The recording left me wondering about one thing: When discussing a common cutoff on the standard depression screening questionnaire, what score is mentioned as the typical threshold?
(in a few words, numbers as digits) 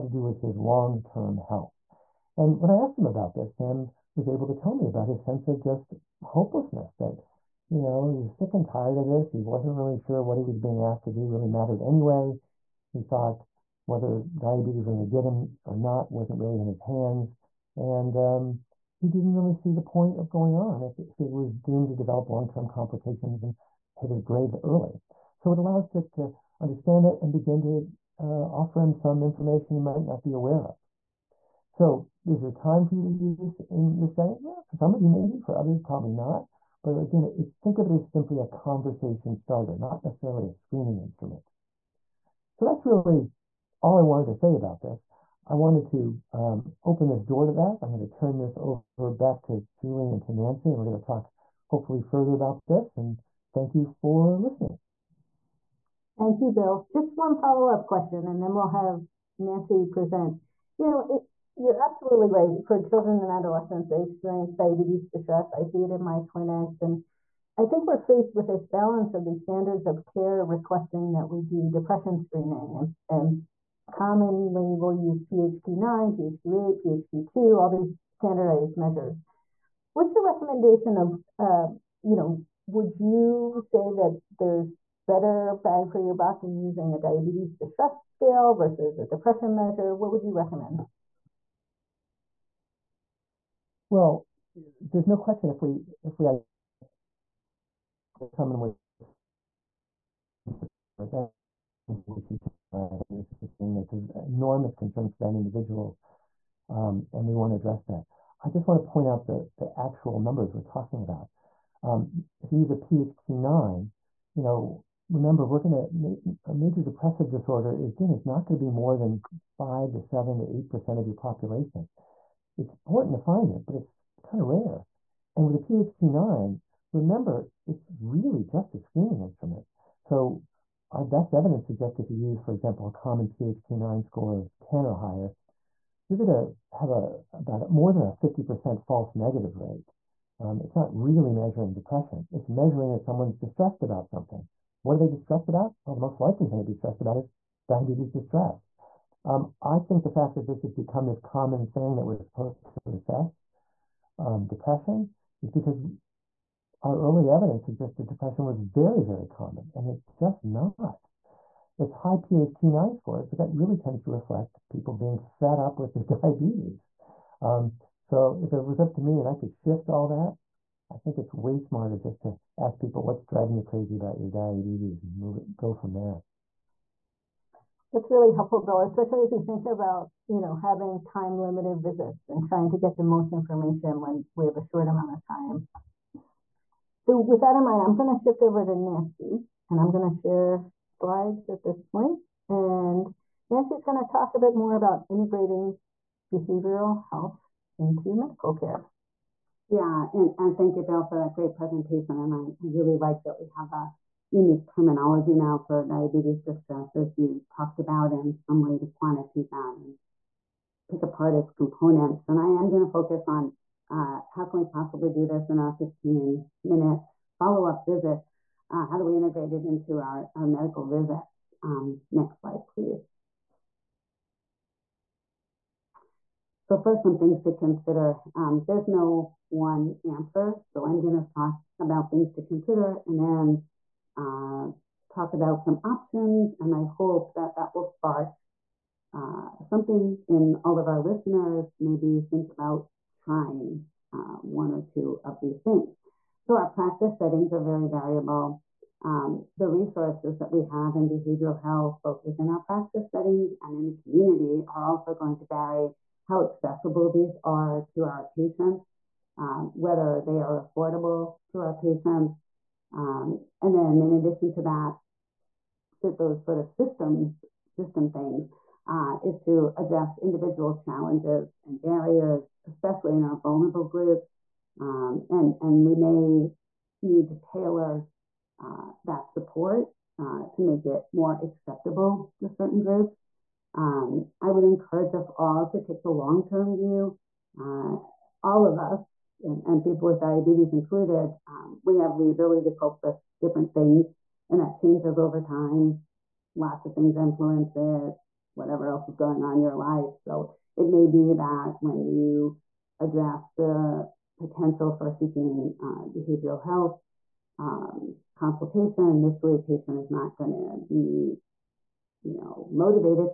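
10 or higher.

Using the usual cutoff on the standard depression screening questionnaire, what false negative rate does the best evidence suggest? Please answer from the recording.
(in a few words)
more than 50%.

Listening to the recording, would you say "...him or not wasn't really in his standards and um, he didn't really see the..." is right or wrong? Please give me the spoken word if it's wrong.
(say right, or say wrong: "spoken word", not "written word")
wrong: "hands", not "standards".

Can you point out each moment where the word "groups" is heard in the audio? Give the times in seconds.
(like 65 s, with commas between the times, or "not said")
273 s, 282 s.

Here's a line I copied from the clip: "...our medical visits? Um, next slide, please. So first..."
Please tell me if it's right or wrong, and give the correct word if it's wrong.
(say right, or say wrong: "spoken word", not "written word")
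right.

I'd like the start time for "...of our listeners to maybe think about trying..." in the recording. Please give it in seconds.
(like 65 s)
240 s.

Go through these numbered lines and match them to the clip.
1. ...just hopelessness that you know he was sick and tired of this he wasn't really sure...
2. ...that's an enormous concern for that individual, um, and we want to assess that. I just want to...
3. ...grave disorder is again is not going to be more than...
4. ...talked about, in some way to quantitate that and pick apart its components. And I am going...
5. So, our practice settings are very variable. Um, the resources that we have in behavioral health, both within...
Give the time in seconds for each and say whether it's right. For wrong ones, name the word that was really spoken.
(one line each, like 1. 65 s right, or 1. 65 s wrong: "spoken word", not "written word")
1. 5 s right
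2. 103 s wrong: "address", not "assess"
3. 116 s wrong: "depressive", not "grave"
4. 207 s right
5. 246 s right.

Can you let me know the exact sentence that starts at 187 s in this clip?
So with that in mind, I'm going to shift over to Nancy and I'm going to share slides at this point.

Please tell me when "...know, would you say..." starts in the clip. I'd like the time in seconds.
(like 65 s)
82 s.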